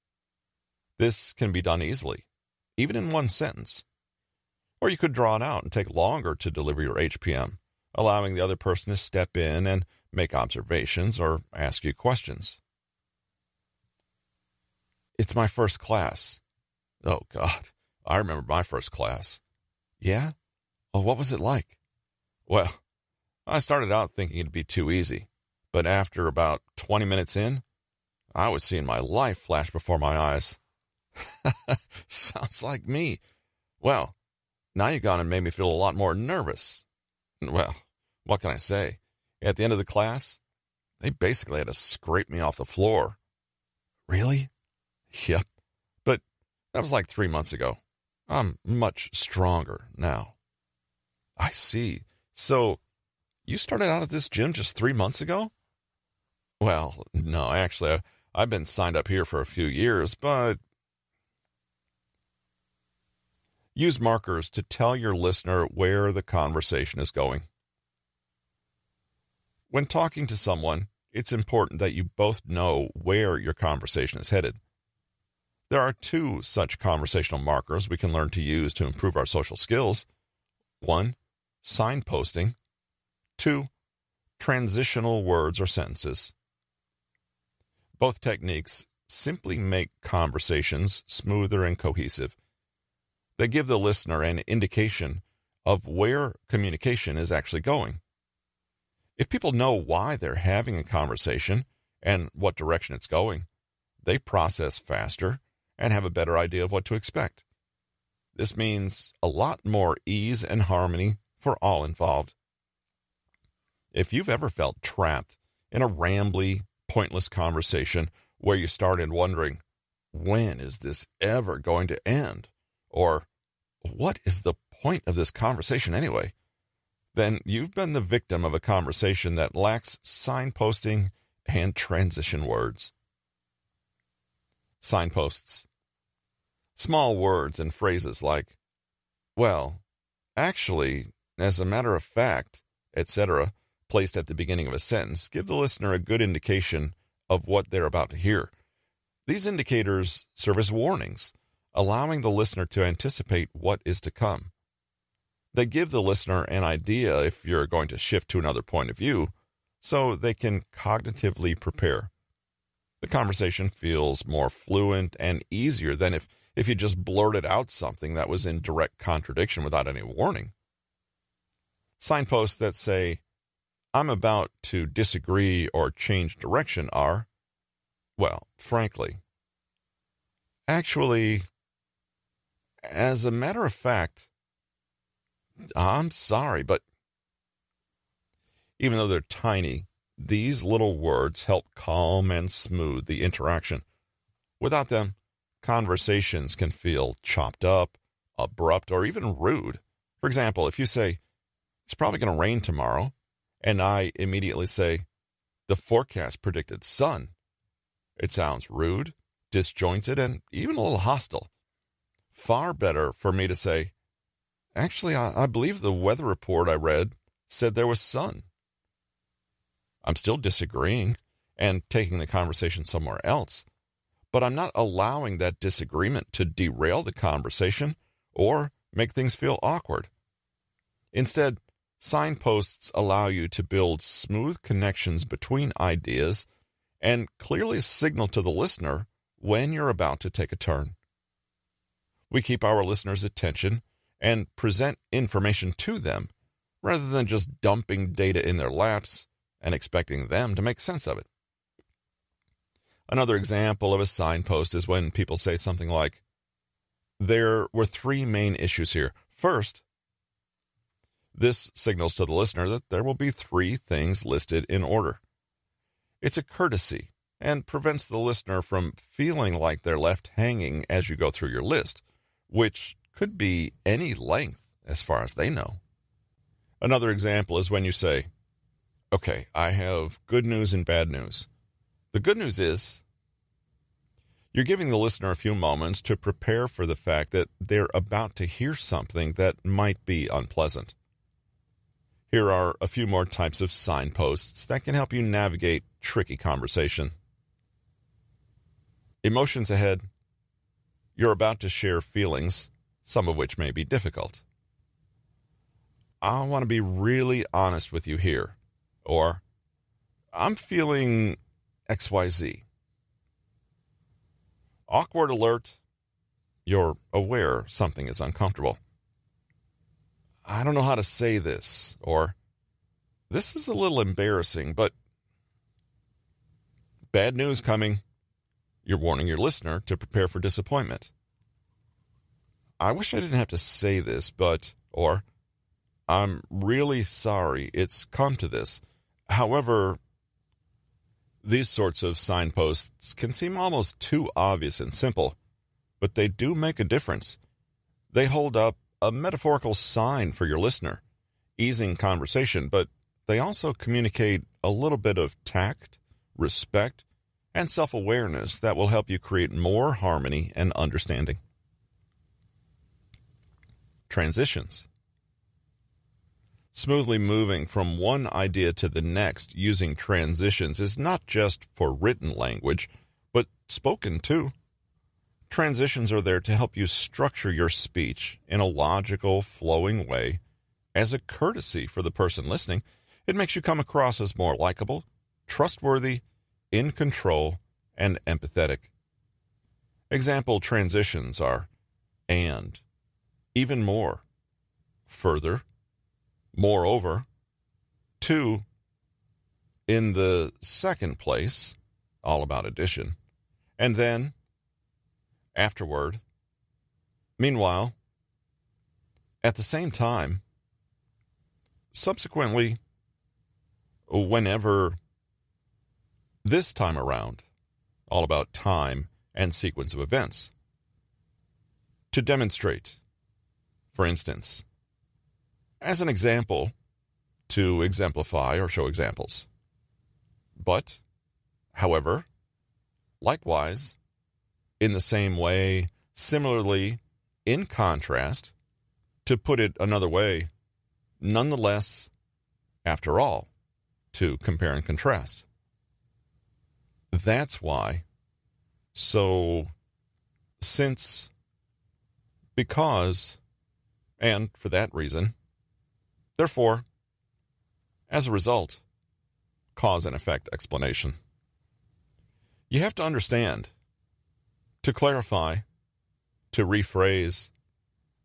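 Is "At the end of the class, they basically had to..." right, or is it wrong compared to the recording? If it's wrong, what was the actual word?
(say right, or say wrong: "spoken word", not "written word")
right.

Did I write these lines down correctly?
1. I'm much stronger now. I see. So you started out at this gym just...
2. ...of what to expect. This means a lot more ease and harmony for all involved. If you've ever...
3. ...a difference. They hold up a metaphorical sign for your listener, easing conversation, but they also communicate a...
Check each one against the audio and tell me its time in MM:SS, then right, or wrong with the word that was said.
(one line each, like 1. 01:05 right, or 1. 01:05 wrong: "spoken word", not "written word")
1. 00:48 right
2. 01:46 right
3. 05:46 right.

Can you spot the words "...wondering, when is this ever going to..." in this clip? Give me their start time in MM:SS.
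01:59.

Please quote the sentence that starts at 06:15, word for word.
Transitions are there to help you structure your speech in a logical, flowing way as a courtesy for the person listening.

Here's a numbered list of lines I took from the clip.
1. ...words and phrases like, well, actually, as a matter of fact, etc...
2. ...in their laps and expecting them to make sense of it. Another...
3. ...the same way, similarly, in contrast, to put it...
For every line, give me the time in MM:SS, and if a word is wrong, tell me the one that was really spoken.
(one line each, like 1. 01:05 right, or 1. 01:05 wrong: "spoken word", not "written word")
1. 02:17 right
2. 04:08 right
3. 07:14 right.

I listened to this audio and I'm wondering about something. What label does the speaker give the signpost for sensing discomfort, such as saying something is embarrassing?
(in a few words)
Awkward alert.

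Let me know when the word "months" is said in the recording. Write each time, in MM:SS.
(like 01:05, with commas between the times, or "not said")
00:47, 00:54.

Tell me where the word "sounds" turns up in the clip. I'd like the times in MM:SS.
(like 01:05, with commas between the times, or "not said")
00:32, 03:28.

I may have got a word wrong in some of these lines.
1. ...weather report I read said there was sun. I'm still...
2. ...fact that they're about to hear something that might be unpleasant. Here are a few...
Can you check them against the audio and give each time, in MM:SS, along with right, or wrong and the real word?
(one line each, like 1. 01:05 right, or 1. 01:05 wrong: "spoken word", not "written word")
1. 03:35 right
2. 04:46 right.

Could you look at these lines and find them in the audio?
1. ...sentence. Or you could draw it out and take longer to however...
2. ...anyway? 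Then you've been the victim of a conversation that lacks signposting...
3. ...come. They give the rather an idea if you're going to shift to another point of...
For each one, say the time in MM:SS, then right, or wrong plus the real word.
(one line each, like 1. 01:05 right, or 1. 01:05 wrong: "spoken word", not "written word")
1. 00:03 wrong: "deliver", not "however"
2. 02:05 right
3. 02:34 wrong: "listener", not "rather".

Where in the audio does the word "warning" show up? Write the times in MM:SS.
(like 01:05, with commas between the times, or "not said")
02:30, 02:50, 05:28.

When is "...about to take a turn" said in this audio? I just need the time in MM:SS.
03:59.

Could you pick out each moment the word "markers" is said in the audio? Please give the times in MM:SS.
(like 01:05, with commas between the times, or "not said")
01:04, 01:17.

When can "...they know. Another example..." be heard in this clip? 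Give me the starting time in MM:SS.
04:35.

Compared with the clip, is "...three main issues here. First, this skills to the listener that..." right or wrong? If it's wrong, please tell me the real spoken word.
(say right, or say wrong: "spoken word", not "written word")
wrong: "signals", not "skills".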